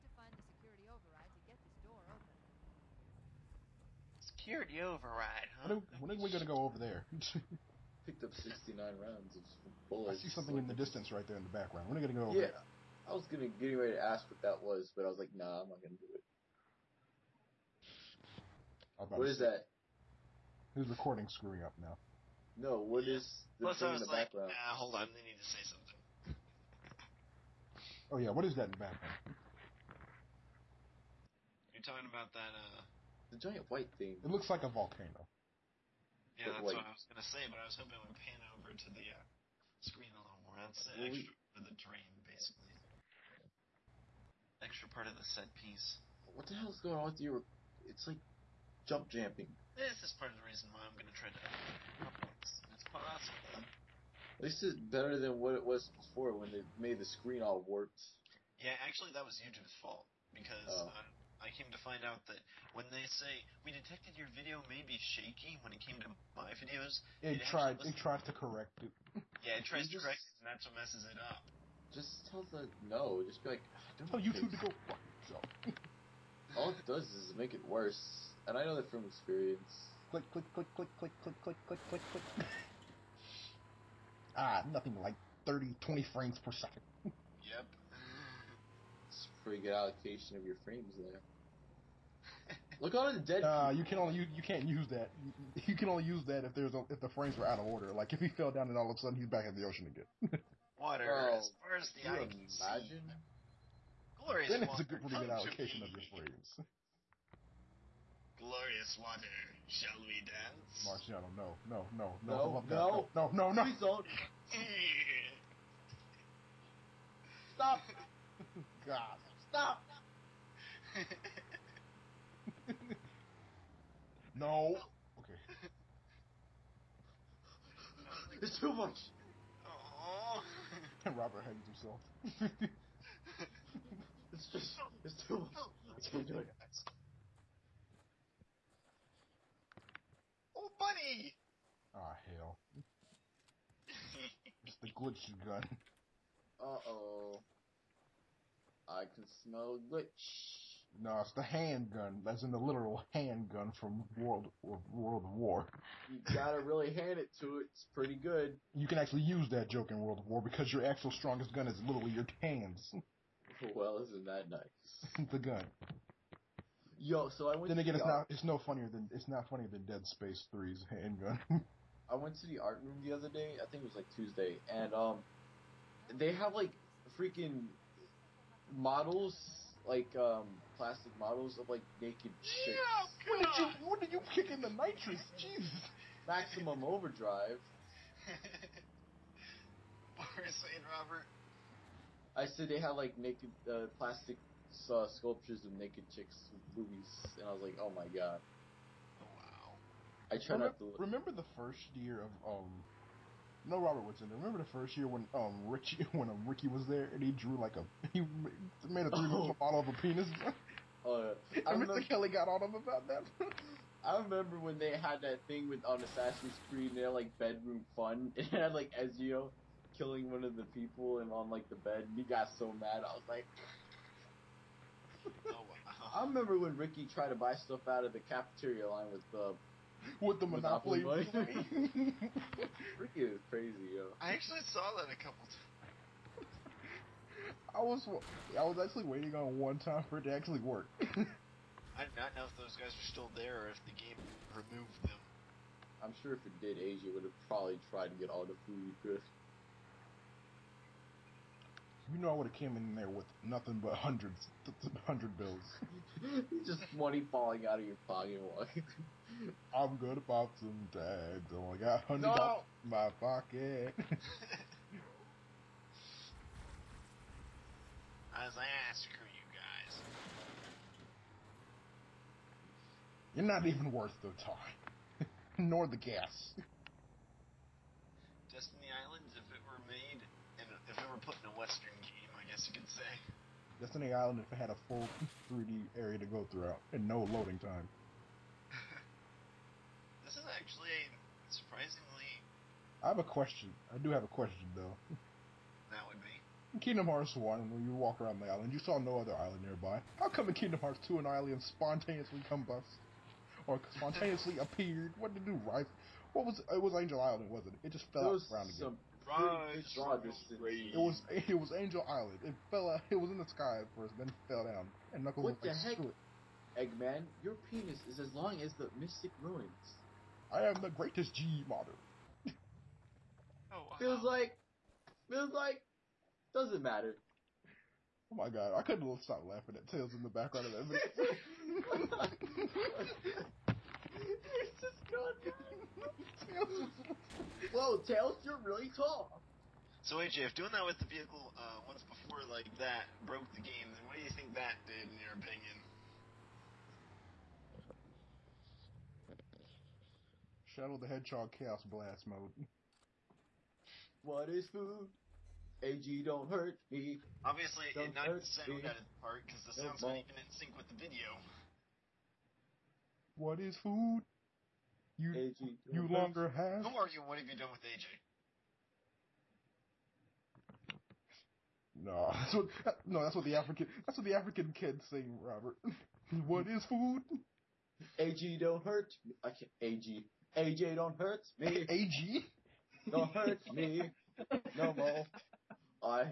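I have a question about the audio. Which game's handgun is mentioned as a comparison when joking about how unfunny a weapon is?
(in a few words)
Dead Space 3.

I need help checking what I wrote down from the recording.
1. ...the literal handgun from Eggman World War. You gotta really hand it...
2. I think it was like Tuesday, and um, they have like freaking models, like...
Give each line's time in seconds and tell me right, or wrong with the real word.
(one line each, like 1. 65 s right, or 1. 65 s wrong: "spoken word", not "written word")
1. 152 s wrong: "World", not "Eggman"
2. 173 s right.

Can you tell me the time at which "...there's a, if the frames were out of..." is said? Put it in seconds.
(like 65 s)
96 s.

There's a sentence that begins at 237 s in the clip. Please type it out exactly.
I was I was actually waiting on one time for it to actually work.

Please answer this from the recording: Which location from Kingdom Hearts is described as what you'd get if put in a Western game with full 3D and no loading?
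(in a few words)
Destiny Islands.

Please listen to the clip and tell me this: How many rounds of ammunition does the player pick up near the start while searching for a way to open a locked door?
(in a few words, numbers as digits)
69.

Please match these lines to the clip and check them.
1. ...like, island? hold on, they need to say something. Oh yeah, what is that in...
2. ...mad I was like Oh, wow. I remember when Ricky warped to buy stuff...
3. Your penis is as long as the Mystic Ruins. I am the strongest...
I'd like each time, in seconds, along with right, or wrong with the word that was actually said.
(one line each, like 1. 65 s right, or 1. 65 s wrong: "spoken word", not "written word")
1. 24 s wrong: "background", not "island"
2. 222 s wrong: "tried", not "warped"
3. 317 s wrong: "greatest", not "strongest".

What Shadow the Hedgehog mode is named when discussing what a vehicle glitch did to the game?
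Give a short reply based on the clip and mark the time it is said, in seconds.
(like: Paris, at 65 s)
Chaos Blast, at 351 s.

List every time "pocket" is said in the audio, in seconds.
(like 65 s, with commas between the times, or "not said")
258 s, 263 s.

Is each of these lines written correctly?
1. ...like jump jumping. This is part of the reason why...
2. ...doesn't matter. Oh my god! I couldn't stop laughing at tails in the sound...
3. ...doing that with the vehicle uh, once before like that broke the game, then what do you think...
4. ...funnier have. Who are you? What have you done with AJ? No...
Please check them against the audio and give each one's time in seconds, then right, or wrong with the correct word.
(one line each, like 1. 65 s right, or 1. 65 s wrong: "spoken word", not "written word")
1. 48 s right
2. 326 s wrong: "background", not "sound"
3. 340 s right
4. 366 s wrong: "longer", not "funnier".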